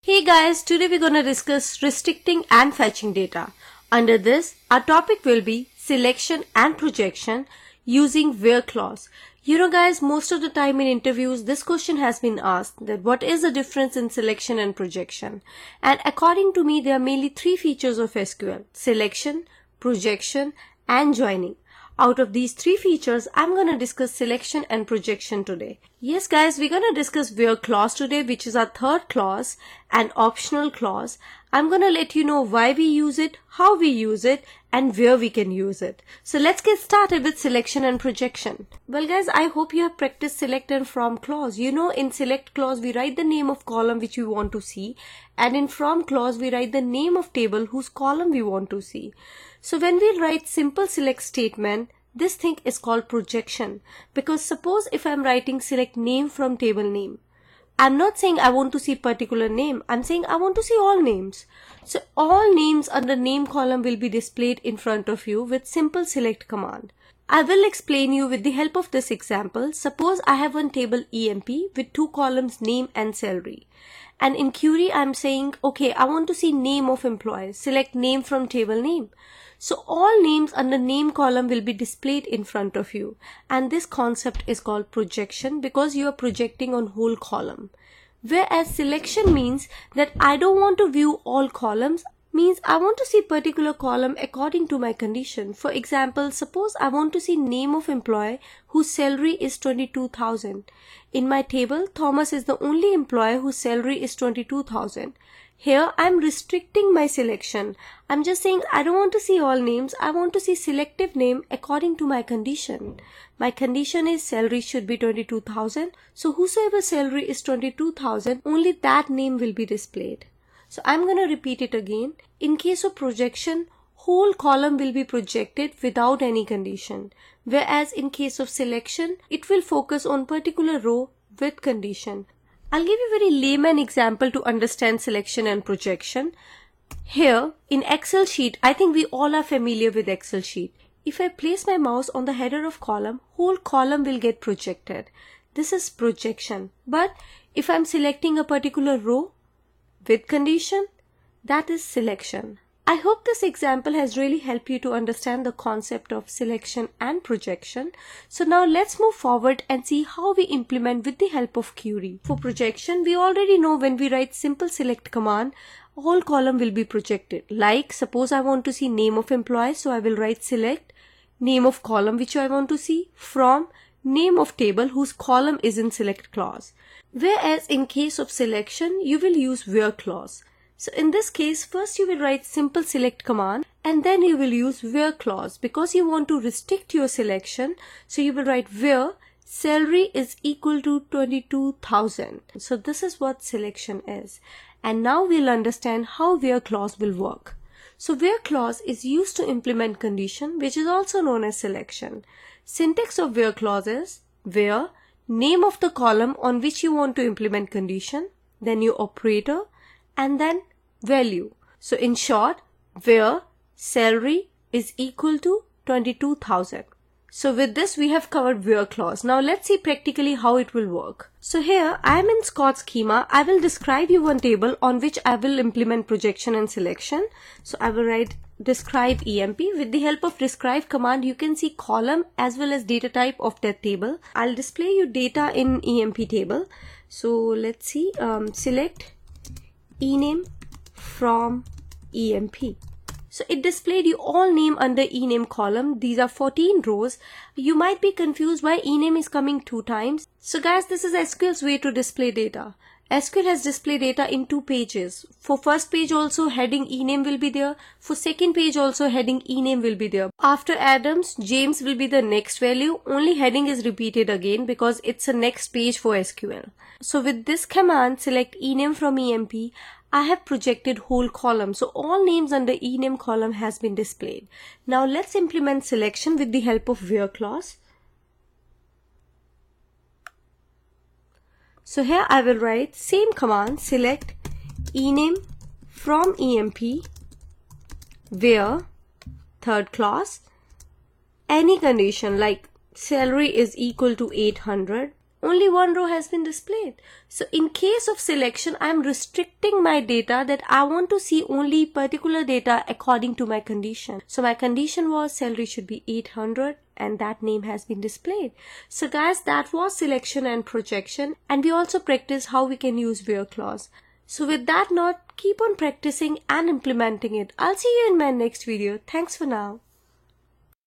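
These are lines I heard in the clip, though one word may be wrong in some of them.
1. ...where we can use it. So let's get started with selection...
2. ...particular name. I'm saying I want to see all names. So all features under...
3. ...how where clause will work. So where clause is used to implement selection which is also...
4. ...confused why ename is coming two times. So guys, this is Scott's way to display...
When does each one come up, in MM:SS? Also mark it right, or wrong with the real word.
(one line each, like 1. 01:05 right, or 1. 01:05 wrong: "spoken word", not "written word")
1. 00:34 right
2. 00:58 wrong: "names", not "features"
3. 03:16 wrong: "condition", not "selection"
4. 04:08 wrong: "SQL", not "Scott".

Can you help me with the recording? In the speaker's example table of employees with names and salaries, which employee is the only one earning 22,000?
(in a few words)
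Thomas.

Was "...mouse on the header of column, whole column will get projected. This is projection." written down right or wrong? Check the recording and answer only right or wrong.
right.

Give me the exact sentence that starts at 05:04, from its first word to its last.
So my condition was salary should be 800 and that name has been displayed.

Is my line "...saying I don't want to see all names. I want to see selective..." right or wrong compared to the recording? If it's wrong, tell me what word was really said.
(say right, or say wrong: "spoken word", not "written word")
right.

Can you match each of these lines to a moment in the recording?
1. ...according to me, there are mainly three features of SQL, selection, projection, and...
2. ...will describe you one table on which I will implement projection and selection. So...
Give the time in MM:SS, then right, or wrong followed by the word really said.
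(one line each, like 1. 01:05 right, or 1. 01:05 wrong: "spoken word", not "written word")
1. 00:16 right
2. 03:43 right.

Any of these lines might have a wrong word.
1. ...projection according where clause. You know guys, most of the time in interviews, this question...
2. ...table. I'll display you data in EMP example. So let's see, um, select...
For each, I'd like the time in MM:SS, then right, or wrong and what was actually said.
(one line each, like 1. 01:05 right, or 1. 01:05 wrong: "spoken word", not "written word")
1. 00:06 wrong: "using", not "according"
2. 03:53 wrong: "table", not "example".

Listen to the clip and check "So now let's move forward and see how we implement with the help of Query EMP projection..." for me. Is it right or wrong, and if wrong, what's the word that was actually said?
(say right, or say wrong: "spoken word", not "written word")
wrong: "For", not "EMP".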